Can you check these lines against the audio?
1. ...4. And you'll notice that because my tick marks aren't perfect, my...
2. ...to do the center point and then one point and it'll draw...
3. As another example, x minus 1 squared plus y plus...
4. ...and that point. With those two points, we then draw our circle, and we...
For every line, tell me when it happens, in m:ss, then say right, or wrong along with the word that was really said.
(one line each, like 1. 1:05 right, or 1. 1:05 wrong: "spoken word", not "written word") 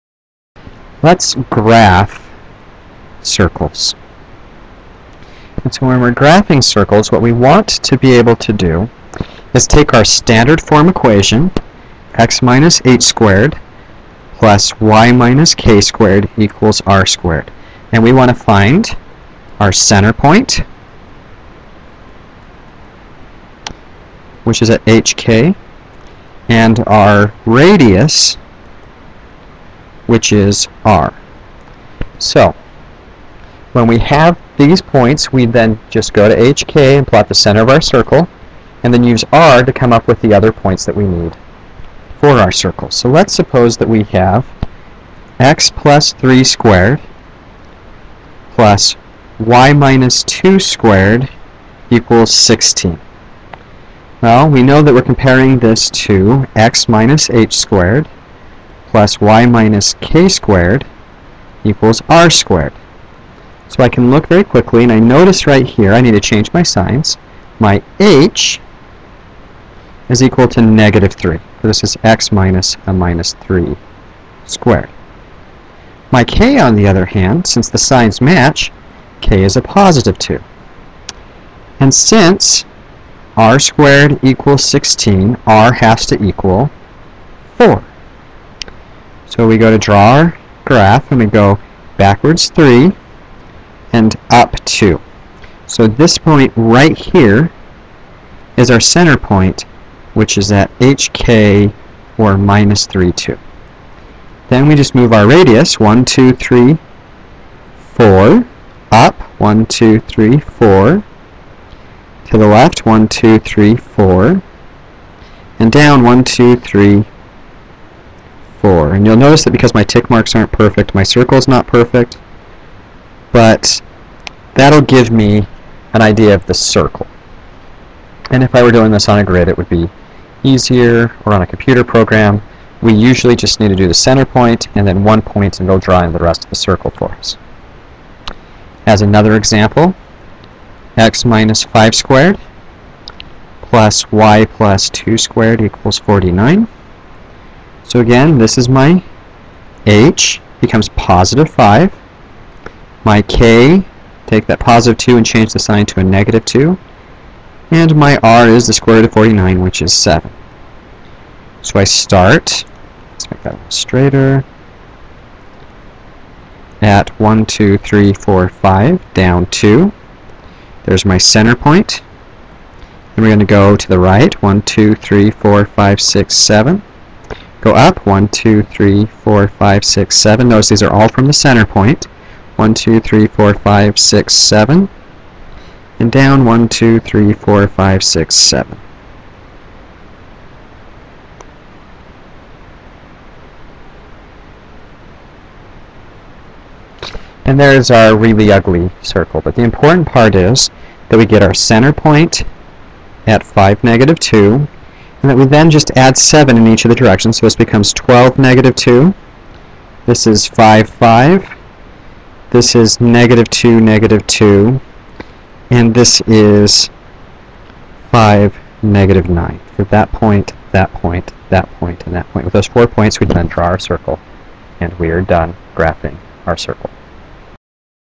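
1. 1:58 right
2. 2:13 right
3. 2:18 wrong: "5", not "1"
4. 3:42 wrong: "four", not "two".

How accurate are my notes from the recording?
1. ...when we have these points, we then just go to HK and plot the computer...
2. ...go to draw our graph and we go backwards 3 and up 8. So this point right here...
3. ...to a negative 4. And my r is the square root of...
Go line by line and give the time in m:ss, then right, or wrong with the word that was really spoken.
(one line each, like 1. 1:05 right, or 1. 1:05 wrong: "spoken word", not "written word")
1. 0:33 wrong: "center", not "computer"
2. 1:29 wrong: "2", not "8"
3. 2:35 wrong: "2", not "4".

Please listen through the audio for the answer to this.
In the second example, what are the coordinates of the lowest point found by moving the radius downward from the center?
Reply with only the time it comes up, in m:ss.
3:38.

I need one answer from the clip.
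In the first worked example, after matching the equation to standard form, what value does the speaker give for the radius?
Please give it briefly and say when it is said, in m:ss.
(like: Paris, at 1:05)
4, at 1:25.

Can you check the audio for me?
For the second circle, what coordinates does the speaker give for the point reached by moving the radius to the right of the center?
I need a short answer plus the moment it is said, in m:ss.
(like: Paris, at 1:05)
(12, -2), at 3:27.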